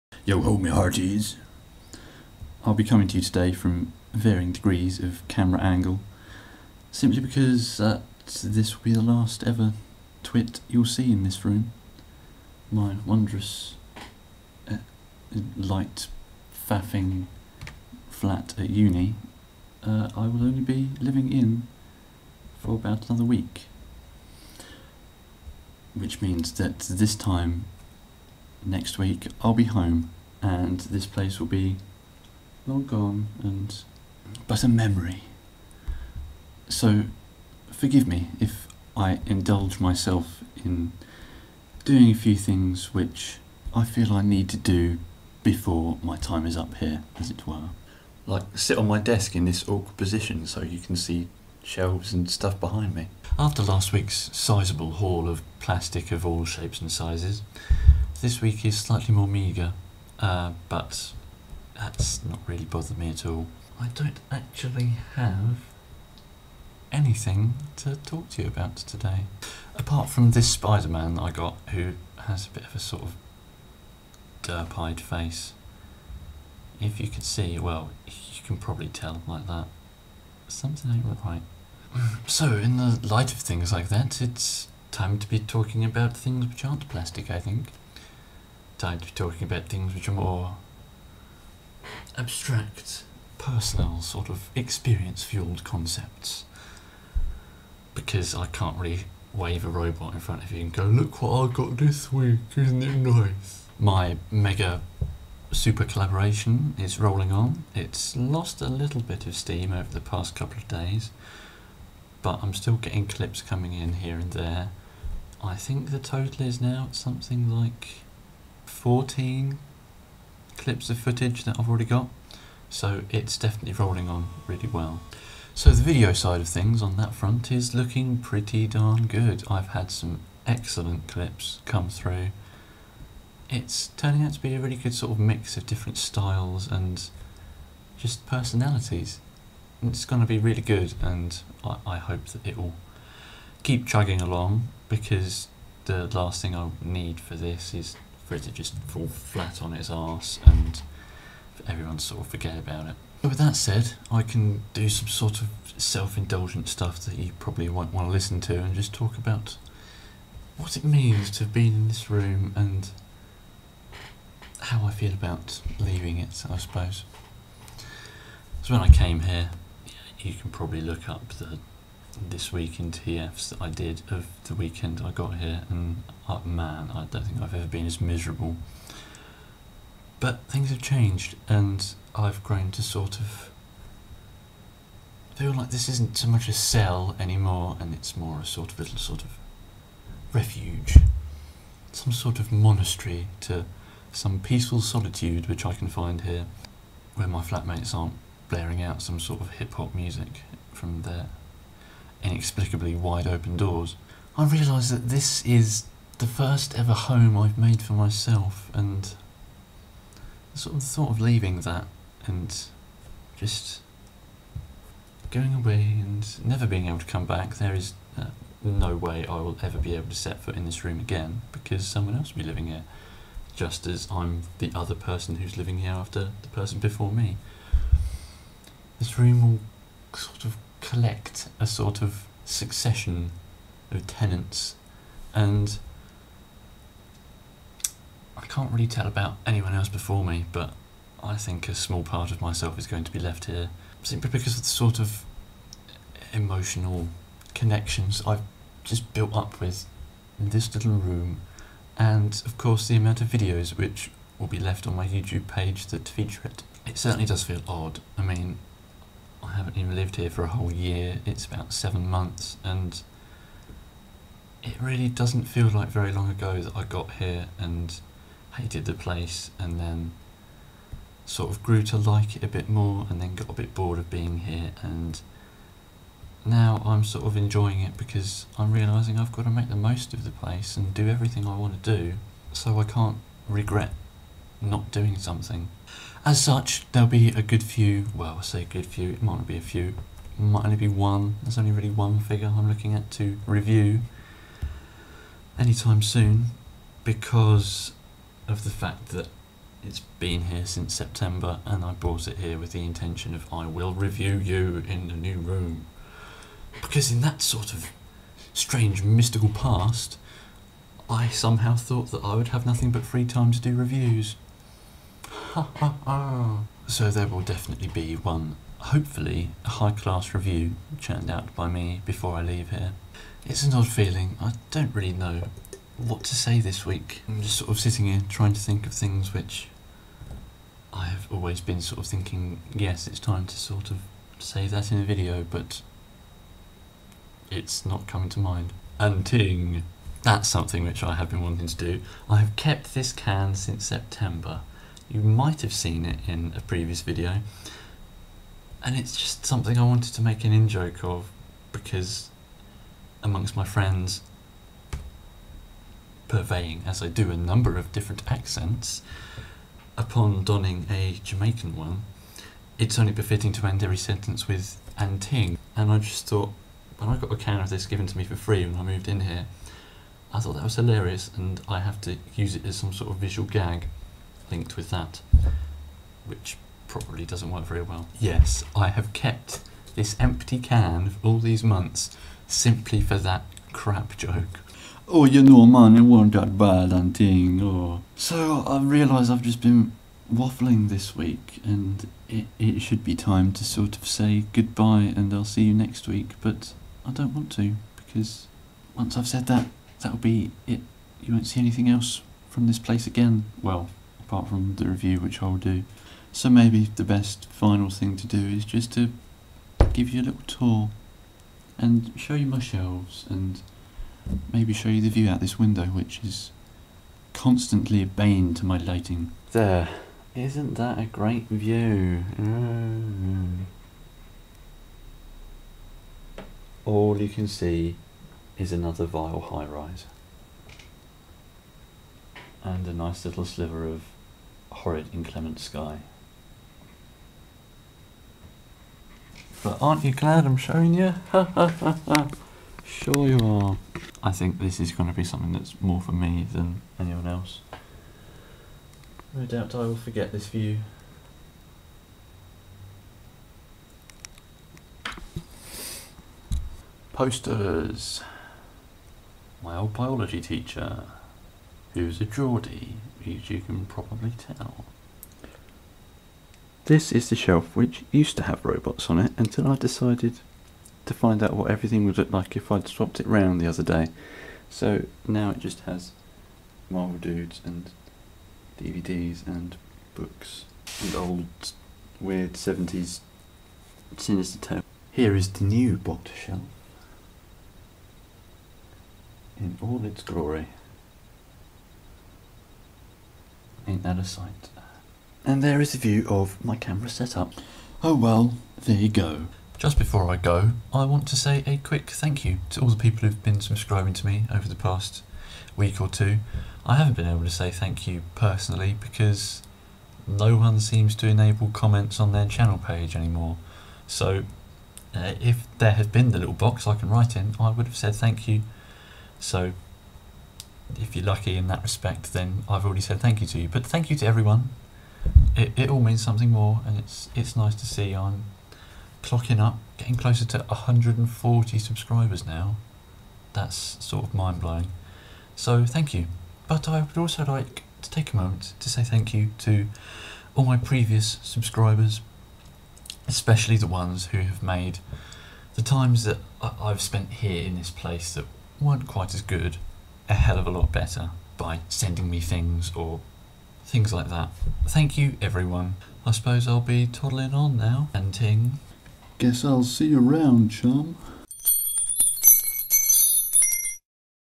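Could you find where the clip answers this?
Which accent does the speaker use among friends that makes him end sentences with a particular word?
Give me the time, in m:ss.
6:01.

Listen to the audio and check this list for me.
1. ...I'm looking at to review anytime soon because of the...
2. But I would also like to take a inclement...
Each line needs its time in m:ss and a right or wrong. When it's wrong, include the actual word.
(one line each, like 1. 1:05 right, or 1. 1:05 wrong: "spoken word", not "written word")
1. 4:52 right
2. 8:56 wrong: "moment", not "inclement".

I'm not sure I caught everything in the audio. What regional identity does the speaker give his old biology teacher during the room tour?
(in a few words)
Geordie.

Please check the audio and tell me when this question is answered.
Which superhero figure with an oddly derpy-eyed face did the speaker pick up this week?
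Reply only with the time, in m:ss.
1:10.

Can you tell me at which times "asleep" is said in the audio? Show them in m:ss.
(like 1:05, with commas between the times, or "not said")
not said.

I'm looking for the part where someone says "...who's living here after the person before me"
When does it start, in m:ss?
3:45.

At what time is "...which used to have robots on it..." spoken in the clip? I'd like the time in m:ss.
7:47.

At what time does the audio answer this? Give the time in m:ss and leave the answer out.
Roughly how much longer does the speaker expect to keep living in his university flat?
0:22.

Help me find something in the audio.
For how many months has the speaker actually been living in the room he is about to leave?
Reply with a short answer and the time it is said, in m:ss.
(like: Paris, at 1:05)
seven months, at 4:21.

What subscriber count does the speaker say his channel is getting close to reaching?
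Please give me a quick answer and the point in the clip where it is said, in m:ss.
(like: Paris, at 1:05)
140, at 8:50.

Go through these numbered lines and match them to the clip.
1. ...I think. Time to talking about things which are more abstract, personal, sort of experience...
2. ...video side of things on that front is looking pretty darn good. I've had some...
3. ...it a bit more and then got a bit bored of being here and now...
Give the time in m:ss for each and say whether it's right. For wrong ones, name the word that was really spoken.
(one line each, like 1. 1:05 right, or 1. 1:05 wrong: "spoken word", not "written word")
1. 1:27 right
2. 2:05 right
3. 4:32 right.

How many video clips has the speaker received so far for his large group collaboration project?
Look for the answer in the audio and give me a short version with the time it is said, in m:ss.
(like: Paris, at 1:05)
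14, at 1:58.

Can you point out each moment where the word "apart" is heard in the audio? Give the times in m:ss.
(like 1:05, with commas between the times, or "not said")
1:09, 6:44.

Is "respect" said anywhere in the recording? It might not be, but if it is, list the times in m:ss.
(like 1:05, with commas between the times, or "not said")
8:41.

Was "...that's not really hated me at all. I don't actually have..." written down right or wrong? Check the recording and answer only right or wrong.
wrong.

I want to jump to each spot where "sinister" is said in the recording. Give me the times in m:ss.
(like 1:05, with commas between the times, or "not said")
8:04.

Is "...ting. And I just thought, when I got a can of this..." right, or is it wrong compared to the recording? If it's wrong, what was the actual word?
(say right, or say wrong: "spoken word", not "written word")
right.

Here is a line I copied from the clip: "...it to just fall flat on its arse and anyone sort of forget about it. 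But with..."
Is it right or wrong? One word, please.
wrong.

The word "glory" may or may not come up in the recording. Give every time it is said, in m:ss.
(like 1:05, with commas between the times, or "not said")
8:10.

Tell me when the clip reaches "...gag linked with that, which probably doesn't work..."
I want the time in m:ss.
6:13.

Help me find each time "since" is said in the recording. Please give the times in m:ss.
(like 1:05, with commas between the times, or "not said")
5:00, 5:43.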